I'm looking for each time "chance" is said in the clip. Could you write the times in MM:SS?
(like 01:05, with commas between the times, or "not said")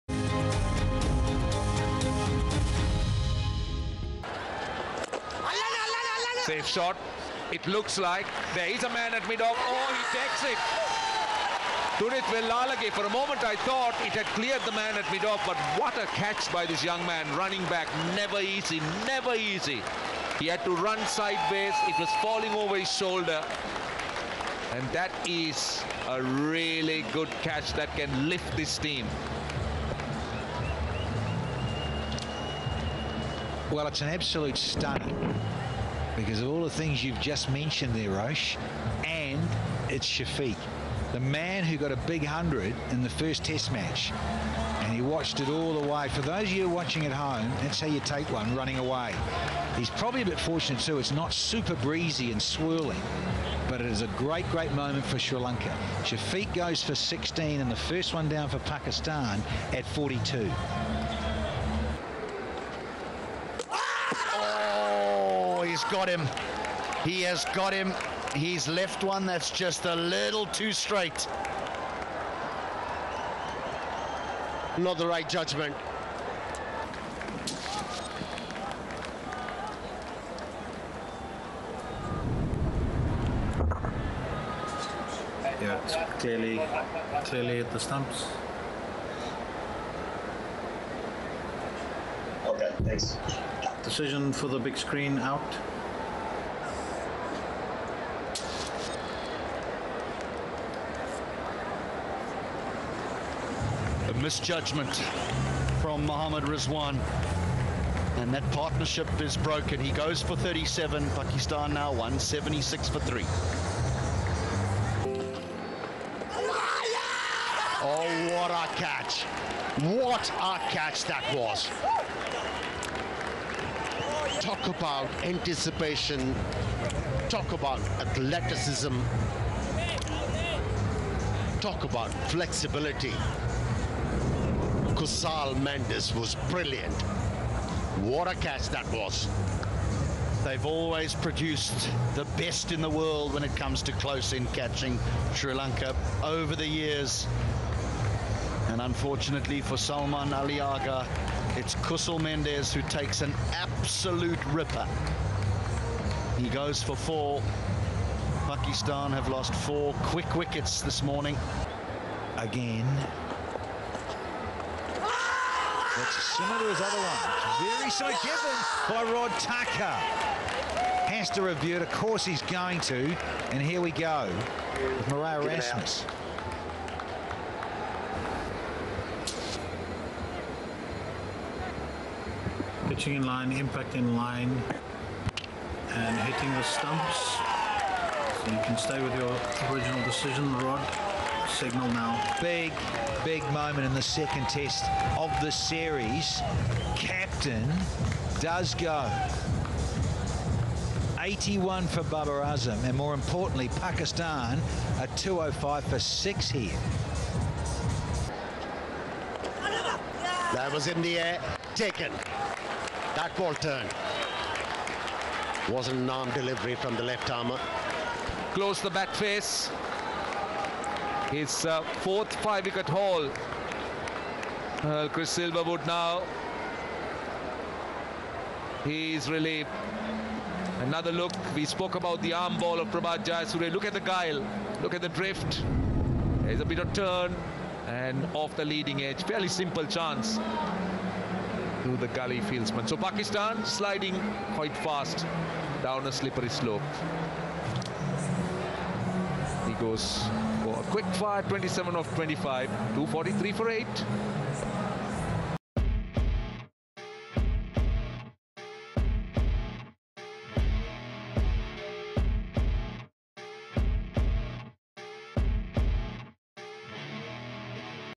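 03:59.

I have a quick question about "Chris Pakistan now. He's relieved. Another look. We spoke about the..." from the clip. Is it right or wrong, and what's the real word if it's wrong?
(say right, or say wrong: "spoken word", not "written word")
wrong: "Silverwood", not "Pakistan".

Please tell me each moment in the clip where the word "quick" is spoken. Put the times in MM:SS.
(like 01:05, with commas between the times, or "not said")
02:40, 04:10.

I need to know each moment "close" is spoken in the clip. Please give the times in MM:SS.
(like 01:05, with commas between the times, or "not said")
02:23, 03:38.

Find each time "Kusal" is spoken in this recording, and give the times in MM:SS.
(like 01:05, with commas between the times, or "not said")
02:14, 02:31.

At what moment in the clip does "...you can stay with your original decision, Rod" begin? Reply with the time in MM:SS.
03:08.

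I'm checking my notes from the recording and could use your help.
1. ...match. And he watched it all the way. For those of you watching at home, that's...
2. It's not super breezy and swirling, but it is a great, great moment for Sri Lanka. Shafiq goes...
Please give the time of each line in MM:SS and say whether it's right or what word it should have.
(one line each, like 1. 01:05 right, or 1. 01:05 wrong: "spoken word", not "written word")
1. 00:43 right
2. 00:50 right.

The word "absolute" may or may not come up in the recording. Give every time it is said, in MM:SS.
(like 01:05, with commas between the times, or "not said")
00:34, 02:33.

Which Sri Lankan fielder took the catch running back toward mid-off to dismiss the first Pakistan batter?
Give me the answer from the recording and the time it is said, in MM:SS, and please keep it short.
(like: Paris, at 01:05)
Dunith Wellalage, at 00:11.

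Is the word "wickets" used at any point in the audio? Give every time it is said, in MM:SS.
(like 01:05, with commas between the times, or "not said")
02:40, 03:42.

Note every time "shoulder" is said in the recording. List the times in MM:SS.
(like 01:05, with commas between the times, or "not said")
00:22.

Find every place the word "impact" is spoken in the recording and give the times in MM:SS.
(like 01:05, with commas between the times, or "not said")
03:03.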